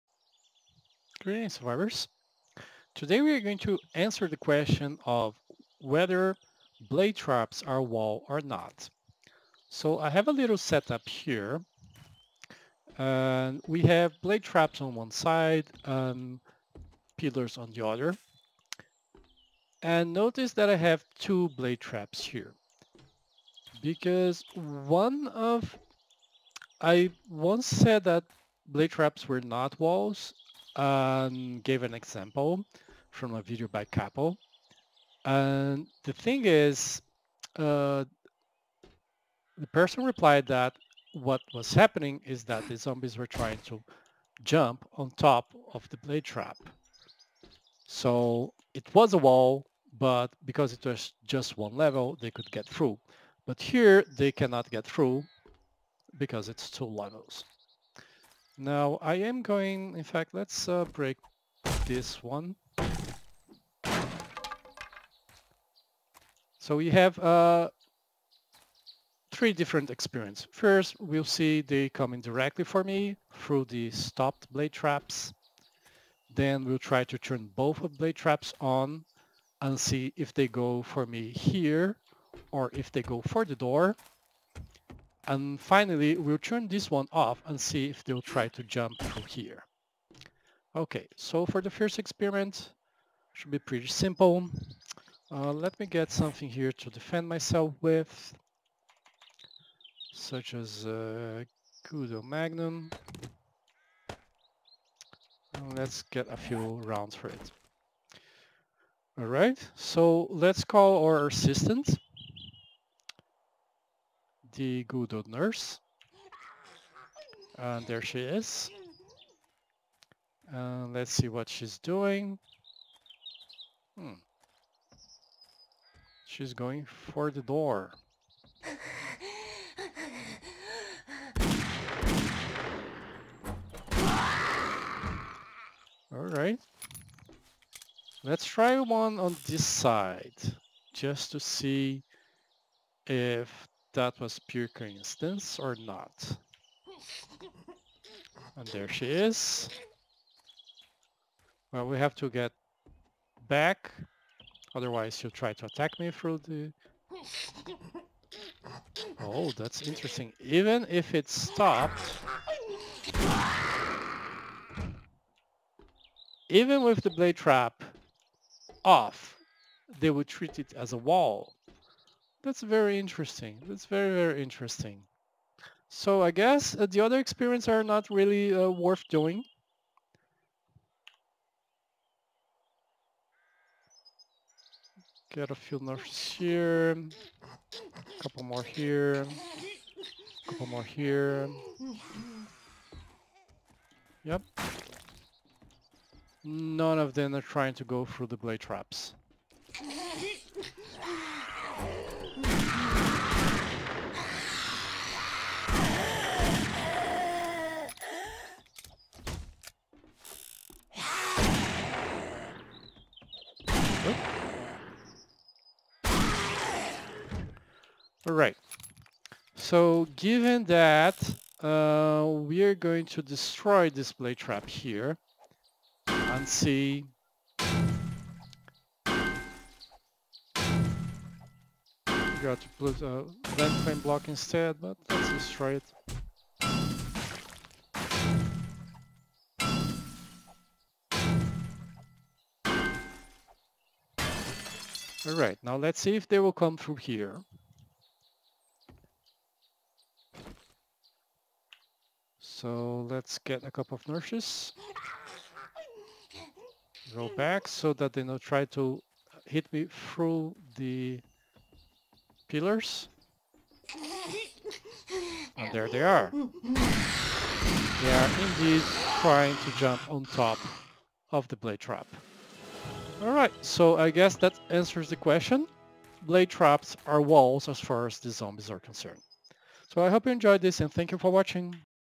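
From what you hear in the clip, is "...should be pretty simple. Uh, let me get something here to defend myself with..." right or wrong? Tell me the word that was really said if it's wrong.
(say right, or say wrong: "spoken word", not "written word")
right.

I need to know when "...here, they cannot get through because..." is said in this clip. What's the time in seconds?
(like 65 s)
53 s.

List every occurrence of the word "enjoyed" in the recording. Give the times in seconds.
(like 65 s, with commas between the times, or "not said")
280 s.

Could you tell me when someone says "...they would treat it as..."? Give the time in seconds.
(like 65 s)
170 s.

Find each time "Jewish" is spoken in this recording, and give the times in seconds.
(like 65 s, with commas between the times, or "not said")
not said.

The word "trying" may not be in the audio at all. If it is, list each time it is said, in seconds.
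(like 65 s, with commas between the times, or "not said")
43 s, 197 s, 269 s.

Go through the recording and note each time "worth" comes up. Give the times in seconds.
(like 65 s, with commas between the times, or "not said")
178 s.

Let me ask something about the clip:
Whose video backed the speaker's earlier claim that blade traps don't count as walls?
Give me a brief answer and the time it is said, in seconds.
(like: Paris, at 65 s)
Capel, at 33 s.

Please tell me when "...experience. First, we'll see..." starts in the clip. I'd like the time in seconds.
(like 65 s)
69 s.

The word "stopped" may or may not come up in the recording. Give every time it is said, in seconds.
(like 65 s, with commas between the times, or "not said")
73 s, 161 s.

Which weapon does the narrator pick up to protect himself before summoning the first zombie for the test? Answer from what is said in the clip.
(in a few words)
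Kudo Magnum.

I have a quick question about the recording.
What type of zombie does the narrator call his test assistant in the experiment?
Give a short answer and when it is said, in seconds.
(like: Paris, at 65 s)
the old nurse, at 114 s.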